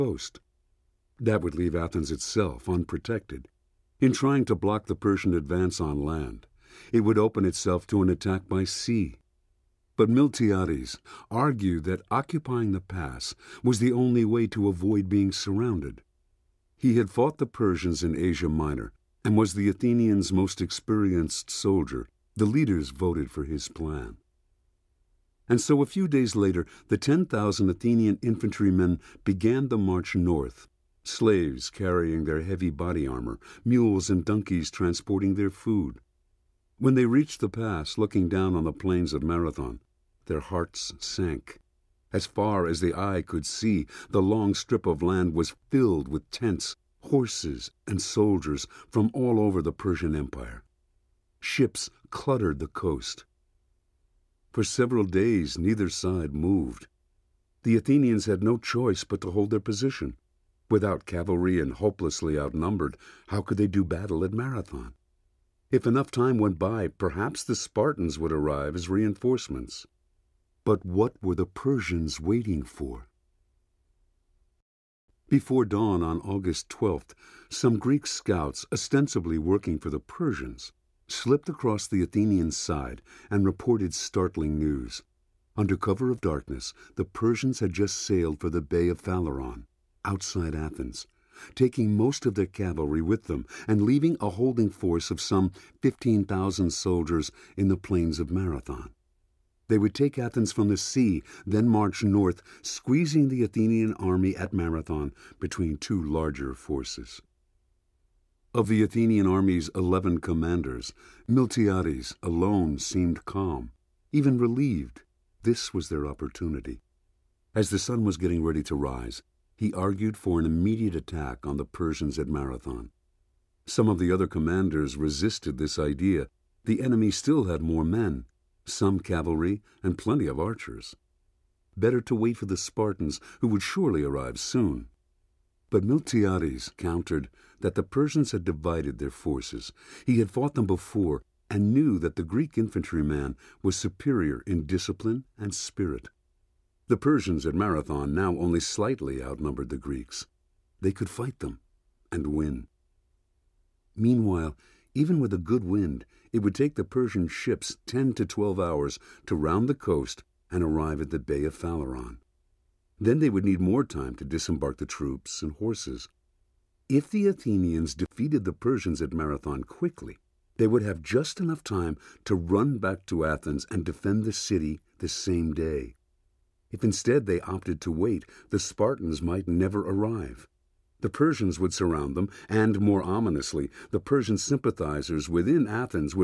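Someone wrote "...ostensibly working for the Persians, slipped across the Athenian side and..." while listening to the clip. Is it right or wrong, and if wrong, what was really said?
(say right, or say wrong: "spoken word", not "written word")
right.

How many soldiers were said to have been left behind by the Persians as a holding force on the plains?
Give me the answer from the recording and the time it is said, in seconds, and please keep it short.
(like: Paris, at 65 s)
15,000, at 95 s.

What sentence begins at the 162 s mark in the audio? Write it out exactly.
Then they would need more time to disembark the troops and horses.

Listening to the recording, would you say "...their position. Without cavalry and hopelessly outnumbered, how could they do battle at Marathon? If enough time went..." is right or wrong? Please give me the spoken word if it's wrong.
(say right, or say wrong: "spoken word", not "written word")
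right.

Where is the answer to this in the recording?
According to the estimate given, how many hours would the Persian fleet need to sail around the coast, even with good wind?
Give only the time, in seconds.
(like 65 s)
157 s.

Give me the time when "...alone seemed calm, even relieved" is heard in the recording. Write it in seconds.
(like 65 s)
112 s.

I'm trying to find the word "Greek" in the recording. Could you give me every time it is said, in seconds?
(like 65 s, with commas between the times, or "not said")
77 s, 142 s, 149 s.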